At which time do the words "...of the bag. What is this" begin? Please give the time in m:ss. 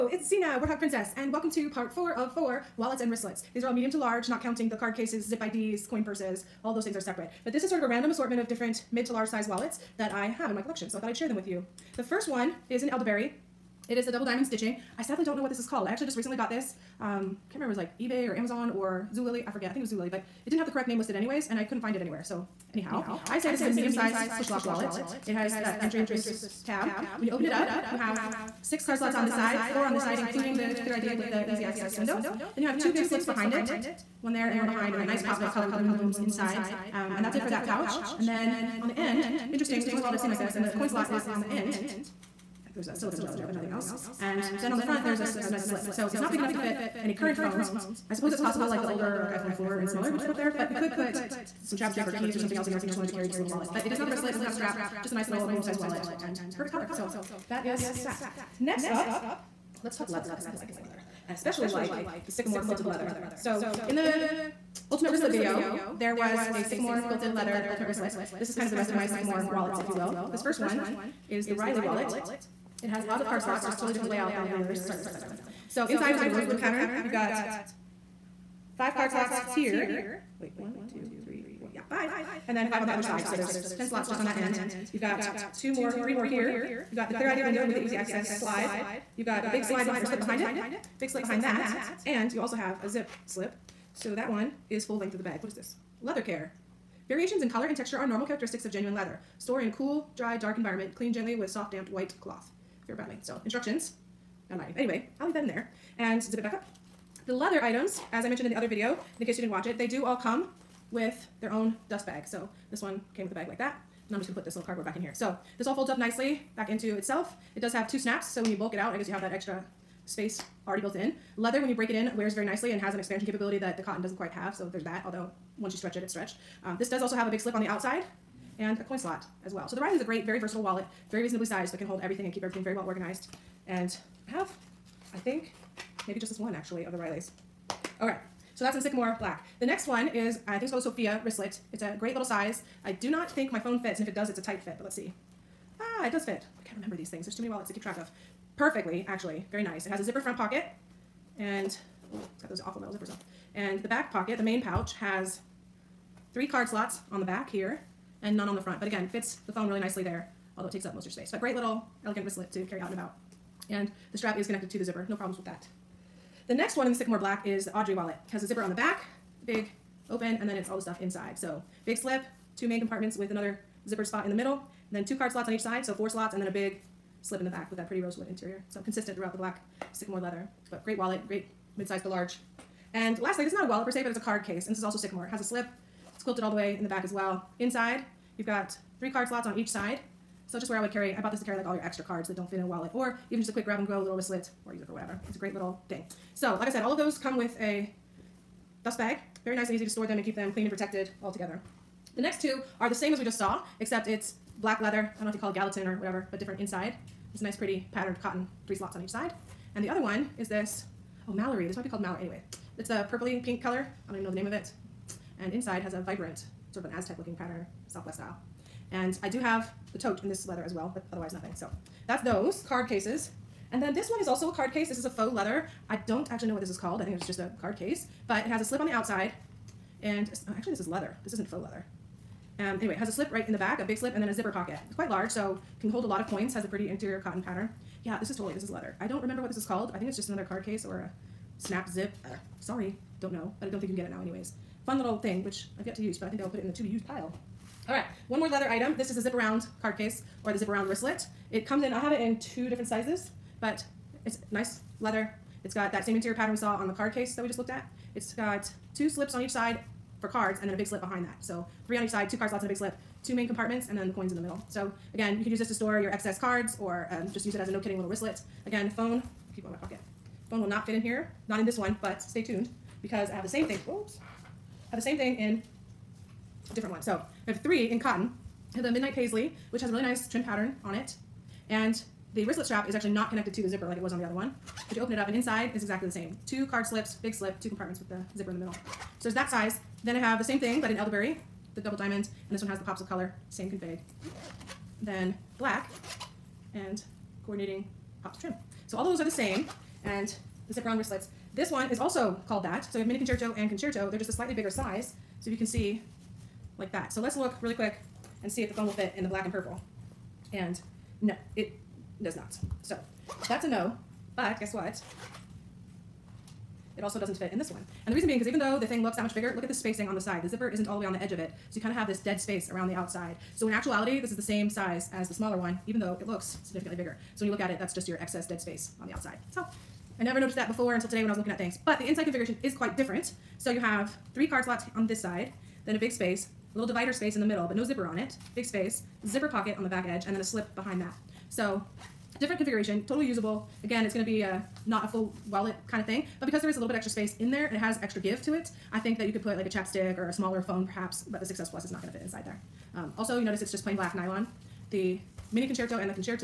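1:35.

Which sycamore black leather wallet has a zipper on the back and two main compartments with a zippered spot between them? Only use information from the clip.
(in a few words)
Audrey.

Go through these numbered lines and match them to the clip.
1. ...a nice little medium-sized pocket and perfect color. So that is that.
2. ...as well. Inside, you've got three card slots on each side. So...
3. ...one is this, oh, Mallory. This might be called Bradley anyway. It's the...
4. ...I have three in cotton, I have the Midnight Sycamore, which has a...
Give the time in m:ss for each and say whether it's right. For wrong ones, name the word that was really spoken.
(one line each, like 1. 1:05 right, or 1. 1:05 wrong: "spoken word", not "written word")
1. 0:55 wrong: "wallet", not "pocket"
2. 3:07 right
3. 3:30 wrong: "Mallory", not "Bradley"
4. 4:37 wrong: "Paisley", not "Sycamore".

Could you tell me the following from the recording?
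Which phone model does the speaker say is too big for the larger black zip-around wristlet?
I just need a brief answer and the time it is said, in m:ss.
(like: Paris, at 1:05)
6S Plus, at 5:51.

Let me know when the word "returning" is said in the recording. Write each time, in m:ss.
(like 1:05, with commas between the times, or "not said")
not said.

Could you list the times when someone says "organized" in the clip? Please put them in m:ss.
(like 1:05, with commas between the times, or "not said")
2:12.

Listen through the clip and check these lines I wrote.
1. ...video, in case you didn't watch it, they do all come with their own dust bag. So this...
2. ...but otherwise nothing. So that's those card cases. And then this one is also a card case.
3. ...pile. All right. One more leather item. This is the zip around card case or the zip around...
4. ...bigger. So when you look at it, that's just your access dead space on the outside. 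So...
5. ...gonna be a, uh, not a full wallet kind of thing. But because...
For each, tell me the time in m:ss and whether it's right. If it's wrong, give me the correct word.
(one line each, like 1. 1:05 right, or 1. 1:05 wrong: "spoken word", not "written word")
1. 1:48 right
2. 3:40 right
3. 4:07 right
4. 5:26 wrong: "excess", not "access"
5. 5:44 right.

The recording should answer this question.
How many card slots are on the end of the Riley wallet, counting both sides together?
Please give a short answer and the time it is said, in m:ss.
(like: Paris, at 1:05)
10, at 1:23.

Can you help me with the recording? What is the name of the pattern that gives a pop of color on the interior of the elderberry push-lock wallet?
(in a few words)
moon blooms.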